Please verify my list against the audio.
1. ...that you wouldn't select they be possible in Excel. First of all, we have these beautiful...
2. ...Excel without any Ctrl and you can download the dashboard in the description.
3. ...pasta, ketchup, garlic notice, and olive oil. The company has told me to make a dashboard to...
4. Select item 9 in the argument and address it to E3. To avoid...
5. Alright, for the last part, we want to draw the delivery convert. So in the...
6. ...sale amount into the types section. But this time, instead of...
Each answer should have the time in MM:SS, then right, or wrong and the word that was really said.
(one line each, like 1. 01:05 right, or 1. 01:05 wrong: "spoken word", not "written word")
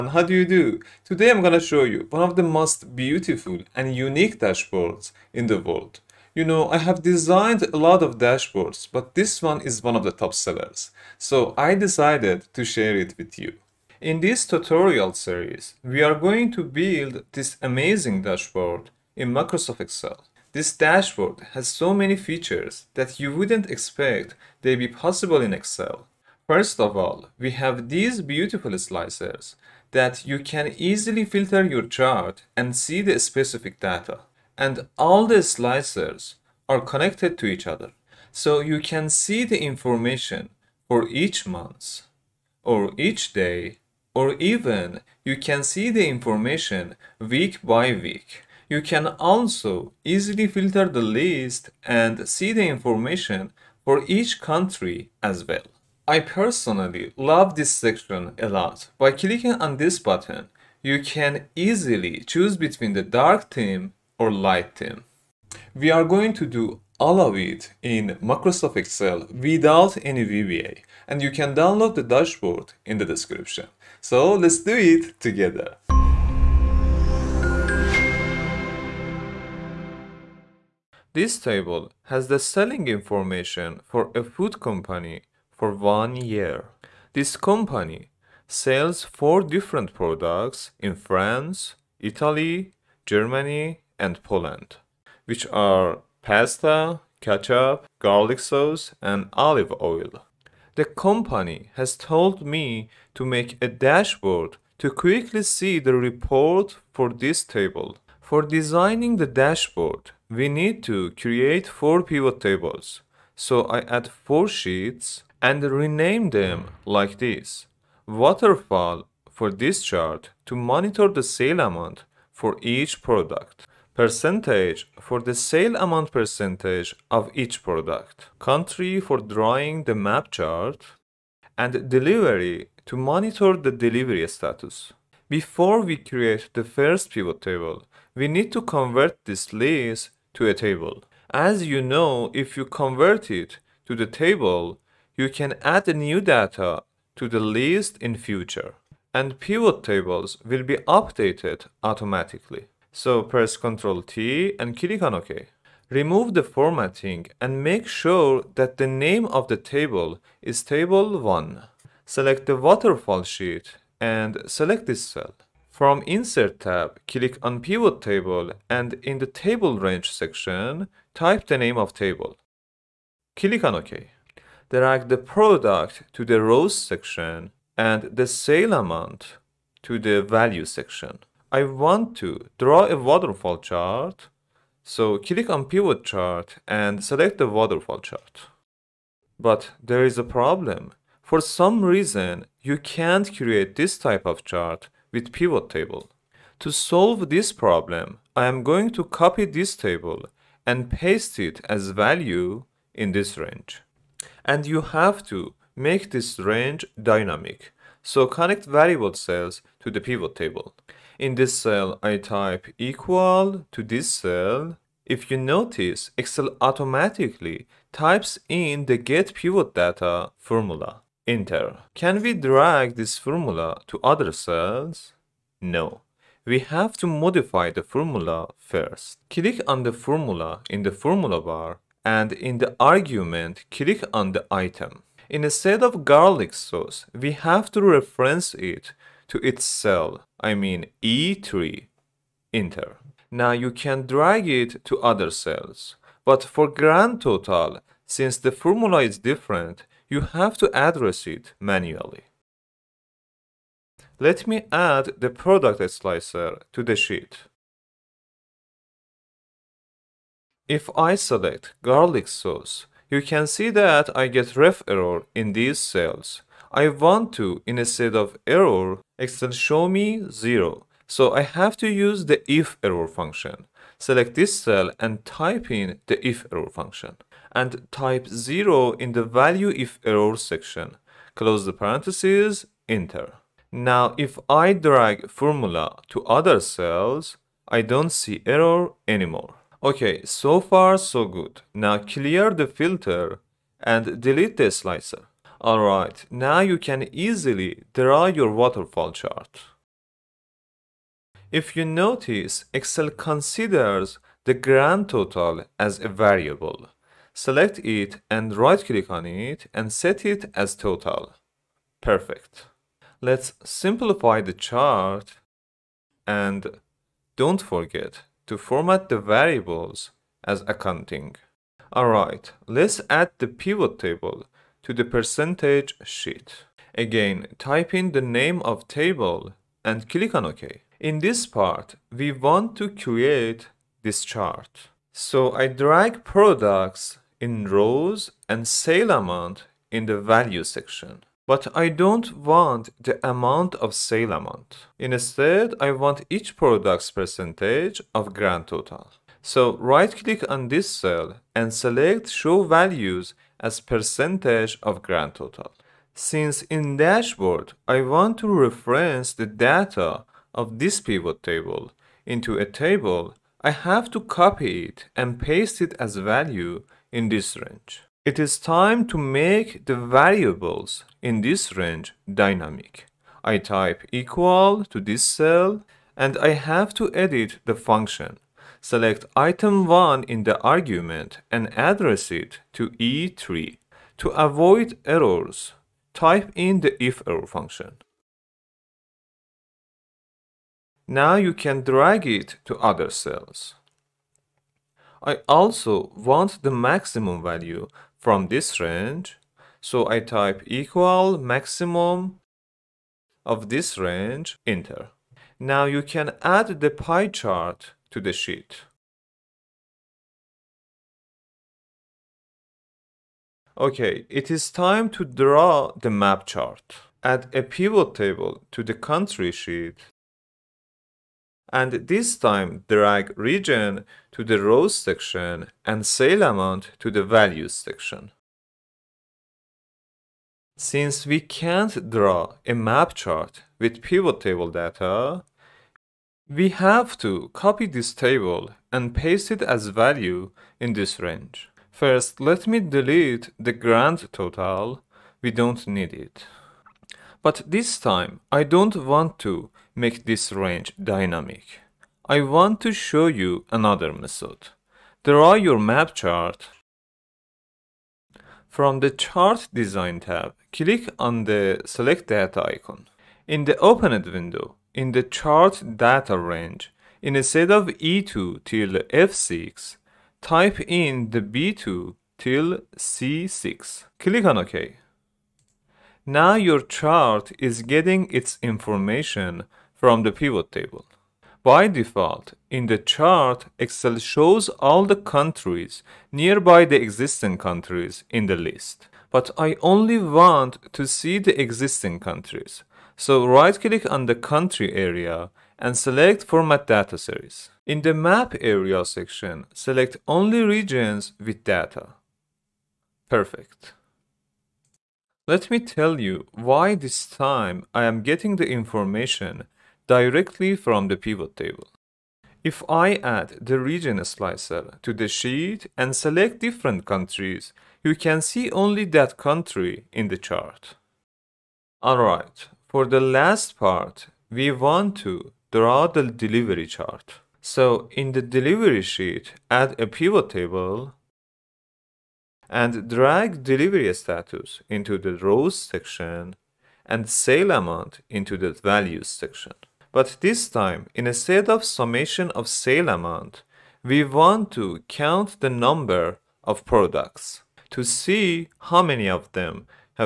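1. 00:22 wrong: "expect", not "select"
2. 01:08 wrong: "VBA", not "Ctrl"
3. 01:36 wrong: "sauce", not "notice"
4. 06:18 wrong: "1", not "9"
5. 08:42 wrong: "chart", not "convert"
6. 08:57 wrong: "values", not "types".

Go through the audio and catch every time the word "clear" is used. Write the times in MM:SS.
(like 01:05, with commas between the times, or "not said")
04:51.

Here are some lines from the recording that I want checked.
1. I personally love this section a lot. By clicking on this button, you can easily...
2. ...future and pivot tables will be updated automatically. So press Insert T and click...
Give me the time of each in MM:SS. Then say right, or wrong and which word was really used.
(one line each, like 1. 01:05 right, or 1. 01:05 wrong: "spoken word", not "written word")
1. 00:56 right
2. 02:28 wrong: "Ctrl", not "Insert".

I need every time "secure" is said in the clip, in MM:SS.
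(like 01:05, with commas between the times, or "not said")
not said.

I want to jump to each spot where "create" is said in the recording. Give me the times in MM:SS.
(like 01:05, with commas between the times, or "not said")
01:51, 02:15, 03:13, 05:32.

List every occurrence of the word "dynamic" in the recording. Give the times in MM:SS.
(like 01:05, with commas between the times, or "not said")
03:27, 06:12, 07:31.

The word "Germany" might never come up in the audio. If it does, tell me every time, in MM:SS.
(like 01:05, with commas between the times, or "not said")
01:33.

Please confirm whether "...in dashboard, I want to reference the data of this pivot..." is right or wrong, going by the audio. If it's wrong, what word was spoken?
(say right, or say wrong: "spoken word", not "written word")
right.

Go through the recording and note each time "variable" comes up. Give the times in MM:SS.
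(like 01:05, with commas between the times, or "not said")
03:28, 05:06, 05:19, 06:09.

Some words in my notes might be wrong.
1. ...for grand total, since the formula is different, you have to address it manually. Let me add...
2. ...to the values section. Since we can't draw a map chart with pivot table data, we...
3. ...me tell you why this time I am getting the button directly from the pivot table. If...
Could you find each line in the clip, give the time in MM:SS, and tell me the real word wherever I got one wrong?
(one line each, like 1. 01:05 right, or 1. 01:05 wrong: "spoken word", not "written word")
1. 04:06 right
2. 07:06 right
3. 08:25 wrong: "information", not "button".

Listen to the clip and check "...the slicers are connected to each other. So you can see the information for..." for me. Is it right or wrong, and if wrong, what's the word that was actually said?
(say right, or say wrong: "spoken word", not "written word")
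right.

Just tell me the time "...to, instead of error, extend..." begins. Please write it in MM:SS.
04:27.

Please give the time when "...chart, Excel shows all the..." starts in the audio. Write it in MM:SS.
08:02.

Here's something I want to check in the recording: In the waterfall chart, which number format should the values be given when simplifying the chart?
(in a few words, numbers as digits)
accounting.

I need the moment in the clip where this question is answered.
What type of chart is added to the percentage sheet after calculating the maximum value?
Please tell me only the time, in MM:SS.
06:46.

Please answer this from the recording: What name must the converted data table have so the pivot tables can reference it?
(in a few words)
table 1.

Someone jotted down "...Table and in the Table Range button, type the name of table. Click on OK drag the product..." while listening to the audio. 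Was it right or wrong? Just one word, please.
wrong.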